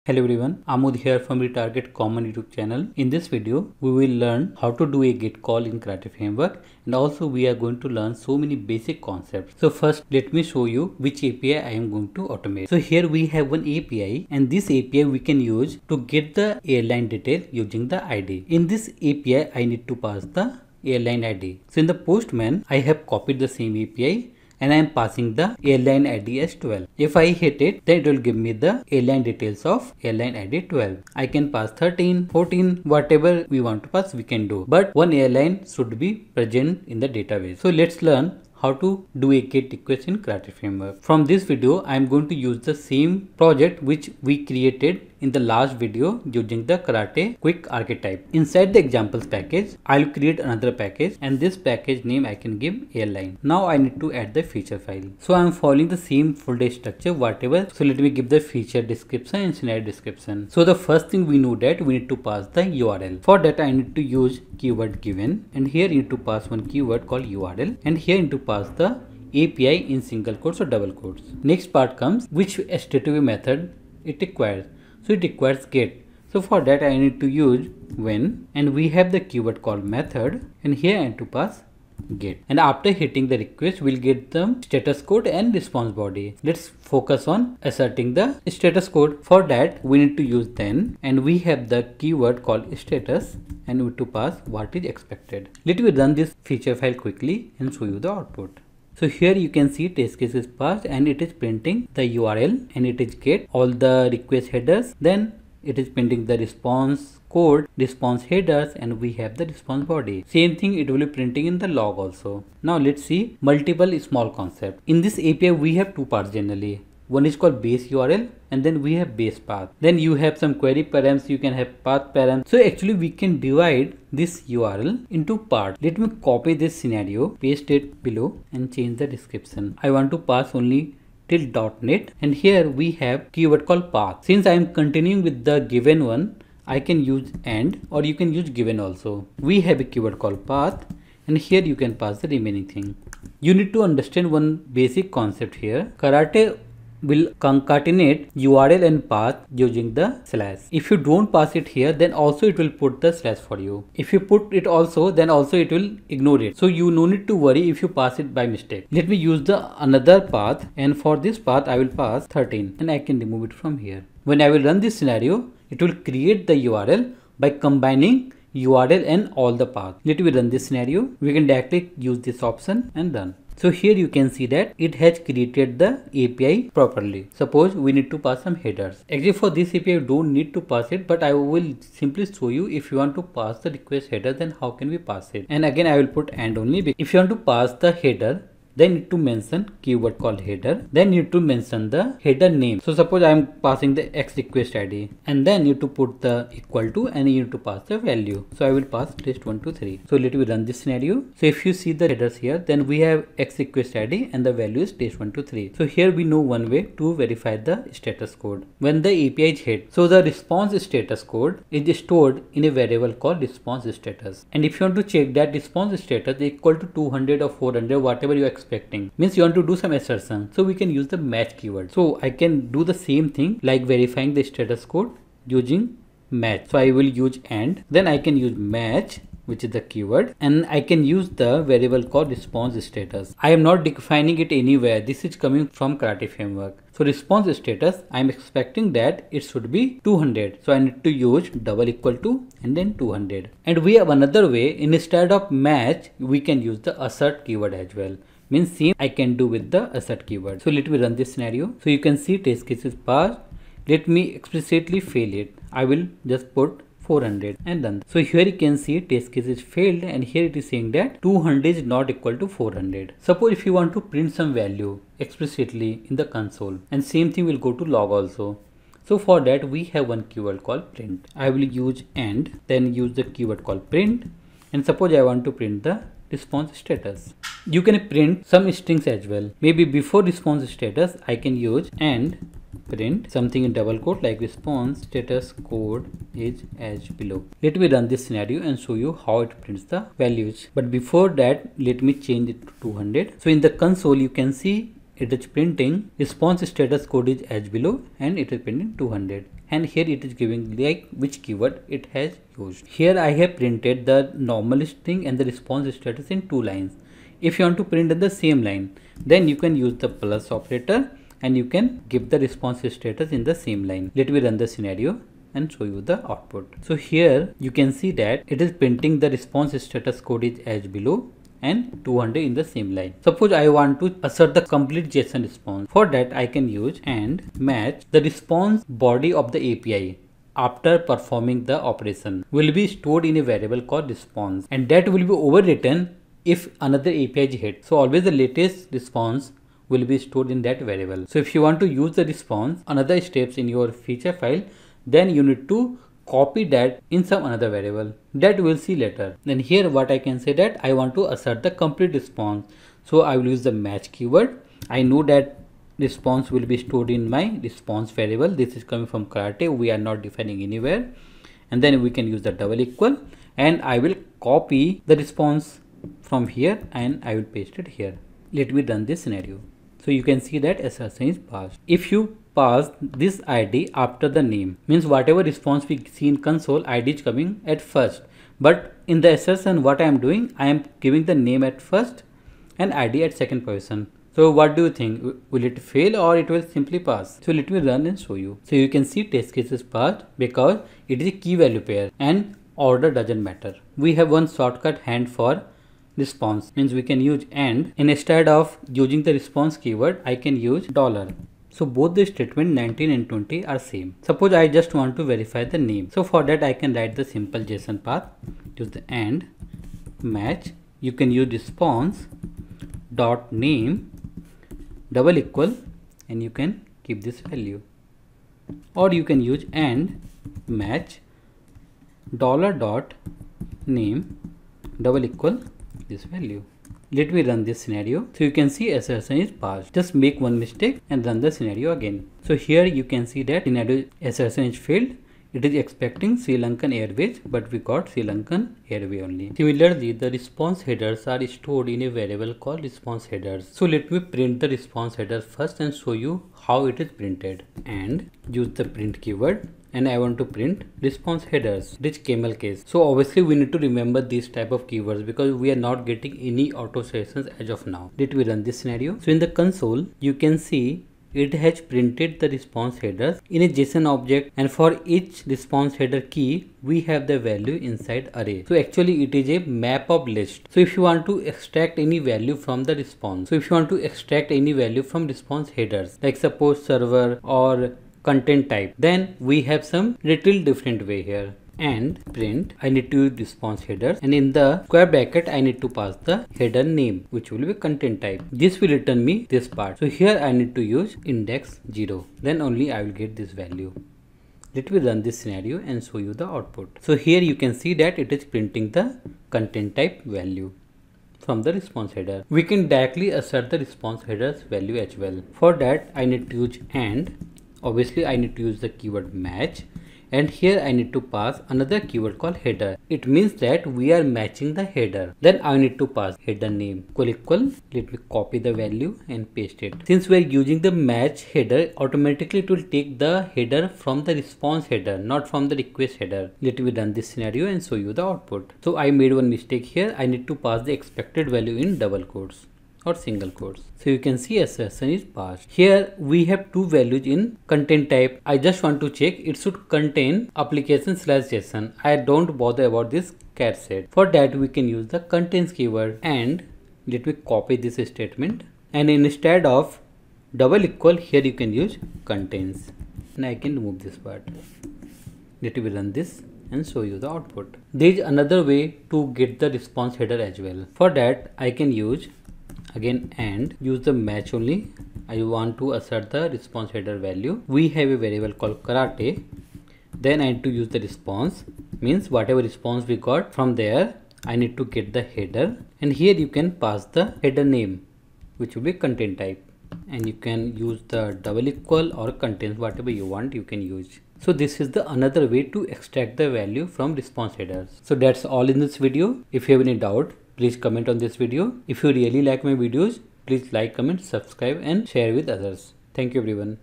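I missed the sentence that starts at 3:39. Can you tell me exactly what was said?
Means you want to do some assertion.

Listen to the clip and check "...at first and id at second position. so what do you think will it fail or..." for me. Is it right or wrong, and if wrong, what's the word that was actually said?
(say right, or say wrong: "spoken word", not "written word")
right.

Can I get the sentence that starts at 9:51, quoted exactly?
If you really like my videos, please like, comment, subscribe and share with others.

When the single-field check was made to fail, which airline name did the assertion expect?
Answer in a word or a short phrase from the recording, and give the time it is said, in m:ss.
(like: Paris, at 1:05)
Sri Lankan Airways, at 7:16.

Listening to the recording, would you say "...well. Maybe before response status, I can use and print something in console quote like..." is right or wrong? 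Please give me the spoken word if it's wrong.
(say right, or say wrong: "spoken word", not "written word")
wrong: "double", not "console".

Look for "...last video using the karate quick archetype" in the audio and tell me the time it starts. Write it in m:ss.
0:45.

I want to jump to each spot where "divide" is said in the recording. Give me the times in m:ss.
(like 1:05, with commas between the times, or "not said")
2:03.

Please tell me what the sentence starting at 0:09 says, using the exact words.
So first, let me show you which API I am going to automate.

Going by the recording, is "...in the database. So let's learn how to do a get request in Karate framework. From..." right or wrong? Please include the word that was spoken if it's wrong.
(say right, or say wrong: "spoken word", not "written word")
right.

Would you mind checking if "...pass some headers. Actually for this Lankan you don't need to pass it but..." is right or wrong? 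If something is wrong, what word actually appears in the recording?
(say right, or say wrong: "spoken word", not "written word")
wrong: "API", not "Lankan".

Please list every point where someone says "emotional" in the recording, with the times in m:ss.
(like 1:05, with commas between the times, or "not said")
not said.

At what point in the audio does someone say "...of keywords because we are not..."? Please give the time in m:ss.
7:34.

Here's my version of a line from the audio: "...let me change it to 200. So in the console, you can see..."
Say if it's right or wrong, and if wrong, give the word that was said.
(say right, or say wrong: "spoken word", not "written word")
right.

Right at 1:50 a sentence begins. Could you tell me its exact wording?
Same thing it will be printing in the log also.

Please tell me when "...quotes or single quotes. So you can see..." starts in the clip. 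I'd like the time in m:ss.
8:52.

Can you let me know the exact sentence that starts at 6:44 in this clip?
Suppose I just want to verify the name.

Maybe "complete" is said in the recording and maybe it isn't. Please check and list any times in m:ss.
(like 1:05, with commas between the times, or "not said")
5:24, 5:51.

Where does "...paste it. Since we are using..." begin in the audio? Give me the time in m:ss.
8:39.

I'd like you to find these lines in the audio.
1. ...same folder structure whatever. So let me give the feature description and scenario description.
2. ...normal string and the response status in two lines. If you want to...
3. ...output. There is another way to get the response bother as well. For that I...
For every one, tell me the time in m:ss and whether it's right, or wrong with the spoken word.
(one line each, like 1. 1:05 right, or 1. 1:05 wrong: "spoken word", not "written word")
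1. 0:55 right
2. 5:04 right
3. 9:17 wrong: "header", not "bother".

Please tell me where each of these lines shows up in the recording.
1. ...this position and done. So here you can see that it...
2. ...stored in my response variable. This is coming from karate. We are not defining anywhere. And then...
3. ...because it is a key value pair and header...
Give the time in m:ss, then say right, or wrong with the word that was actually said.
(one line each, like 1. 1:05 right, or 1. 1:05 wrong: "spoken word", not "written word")
1. 2:52 wrong: "option", not "position"
2. 5:56 right
3. 6:30 wrong: "order", not "header".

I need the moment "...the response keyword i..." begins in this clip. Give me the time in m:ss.
6:39.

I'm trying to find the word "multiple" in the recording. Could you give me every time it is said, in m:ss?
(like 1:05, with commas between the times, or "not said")
1:53.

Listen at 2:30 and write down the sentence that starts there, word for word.
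If you don't pass it here, then also it will put the slash for you.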